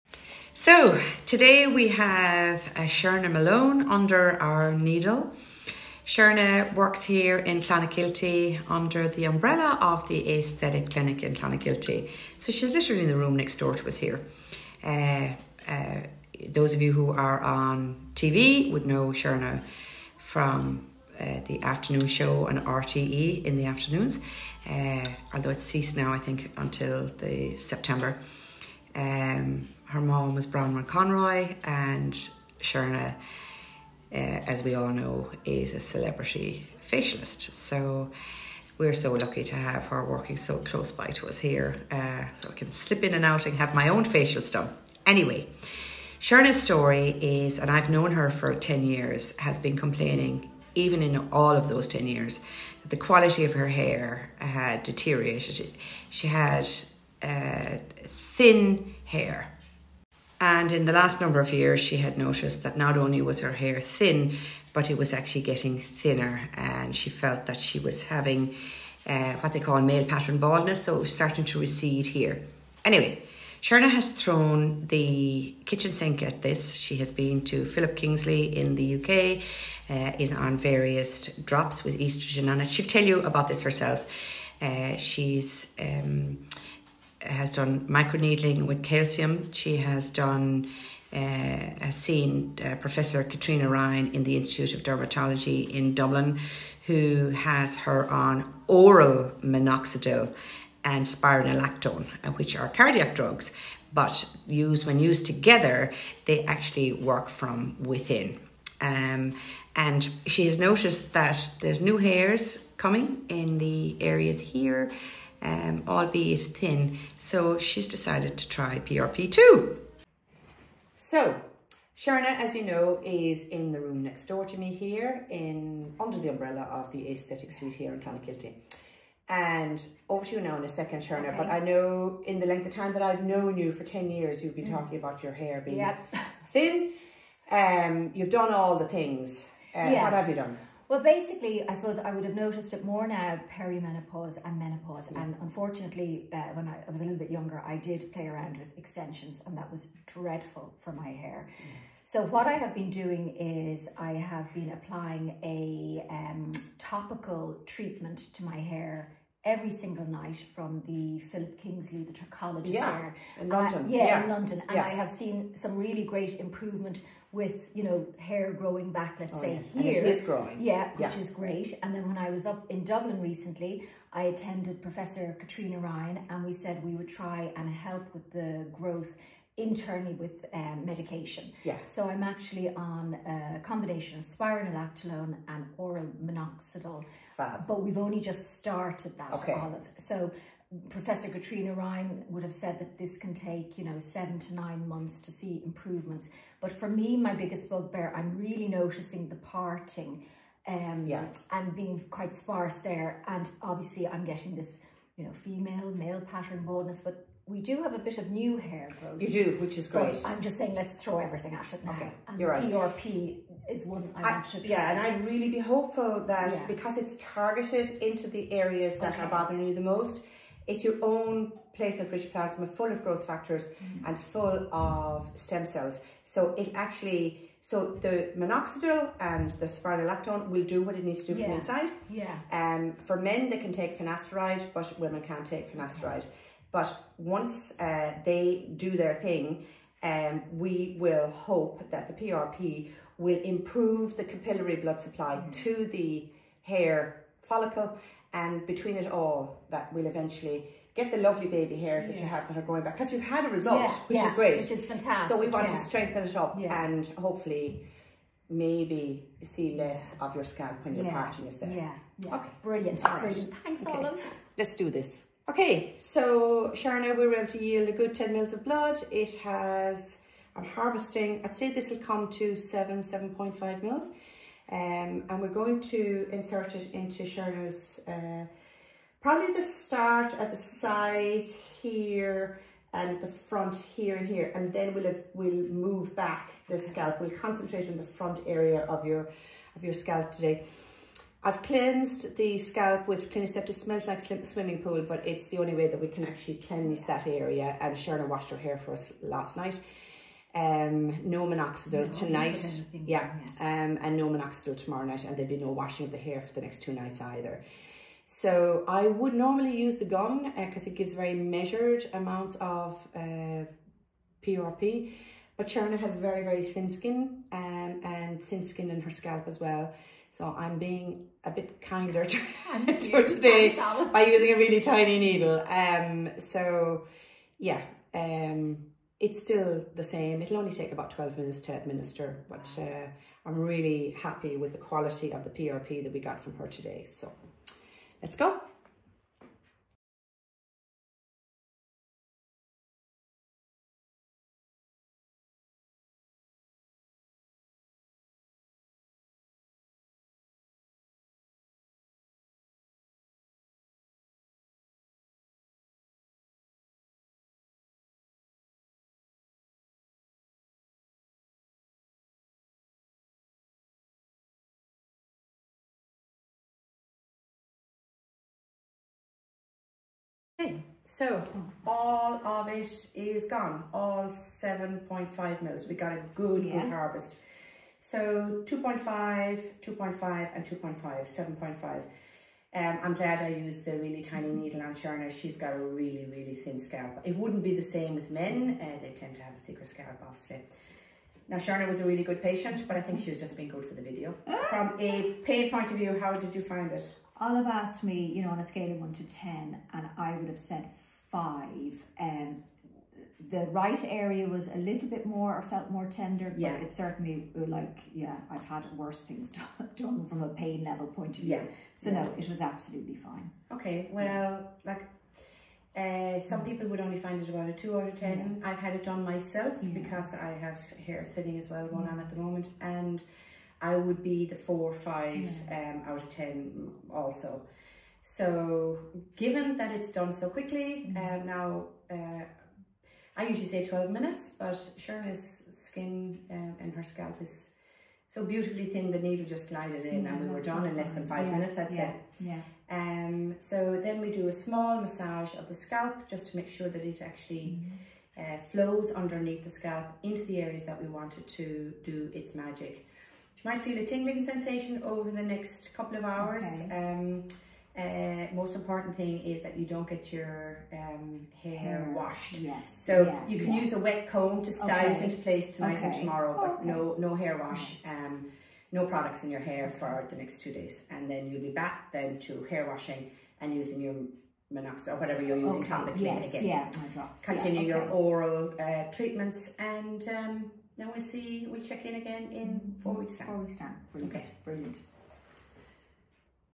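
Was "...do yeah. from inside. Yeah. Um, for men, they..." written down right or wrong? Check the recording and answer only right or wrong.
right.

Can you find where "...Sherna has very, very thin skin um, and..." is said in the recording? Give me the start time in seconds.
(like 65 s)
315 s.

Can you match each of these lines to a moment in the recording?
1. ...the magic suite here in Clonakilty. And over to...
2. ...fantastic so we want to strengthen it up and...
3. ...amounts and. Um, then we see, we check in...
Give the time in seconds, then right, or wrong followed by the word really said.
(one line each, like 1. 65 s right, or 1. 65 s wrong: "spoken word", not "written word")
1. 126 s wrong: "aesthetic", not "magic"
2. 254 s right
3. 479 s wrong: "treatments", not "amounts".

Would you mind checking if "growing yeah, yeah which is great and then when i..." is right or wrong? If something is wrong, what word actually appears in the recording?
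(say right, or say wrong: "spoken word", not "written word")
right.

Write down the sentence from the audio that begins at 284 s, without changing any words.
And then we'll, have, we'll move back the scalp.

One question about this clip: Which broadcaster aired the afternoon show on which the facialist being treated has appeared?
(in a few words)
RTE.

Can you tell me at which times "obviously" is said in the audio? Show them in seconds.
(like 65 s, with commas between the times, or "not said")
203 s, 390 s.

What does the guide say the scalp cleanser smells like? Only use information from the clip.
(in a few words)
Swimming pool.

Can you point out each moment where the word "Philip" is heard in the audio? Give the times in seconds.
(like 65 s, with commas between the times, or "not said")
77 s, 161 s.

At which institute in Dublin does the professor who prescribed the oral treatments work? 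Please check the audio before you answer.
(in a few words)
Institute of Dermatology.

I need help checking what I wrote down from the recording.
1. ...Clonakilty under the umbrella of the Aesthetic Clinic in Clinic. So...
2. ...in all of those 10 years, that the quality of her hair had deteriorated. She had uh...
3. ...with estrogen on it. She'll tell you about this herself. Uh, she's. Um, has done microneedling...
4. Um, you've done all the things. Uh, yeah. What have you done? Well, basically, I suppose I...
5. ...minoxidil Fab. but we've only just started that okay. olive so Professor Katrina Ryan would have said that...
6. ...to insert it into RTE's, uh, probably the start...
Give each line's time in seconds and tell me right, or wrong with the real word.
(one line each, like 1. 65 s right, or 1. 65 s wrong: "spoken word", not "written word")
1. 7 s wrong: "Clonakilty", not "Clinic"
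2. 51 s right
3. 81 s right
4. 137 s right
5. 186 s right
6. 275 s wrong: "Sherna", not "RTE".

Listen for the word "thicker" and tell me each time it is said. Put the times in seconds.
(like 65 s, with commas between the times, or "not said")
389 s.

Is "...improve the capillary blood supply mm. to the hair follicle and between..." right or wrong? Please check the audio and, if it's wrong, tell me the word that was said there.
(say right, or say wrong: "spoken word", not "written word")
right.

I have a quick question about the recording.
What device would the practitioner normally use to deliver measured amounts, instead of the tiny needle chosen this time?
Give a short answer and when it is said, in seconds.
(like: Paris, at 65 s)
The gun, at 309 s.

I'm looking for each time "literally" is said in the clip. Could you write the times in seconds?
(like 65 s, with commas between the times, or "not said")
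12 s.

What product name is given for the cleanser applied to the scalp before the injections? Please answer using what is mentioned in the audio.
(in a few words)
Clinisept.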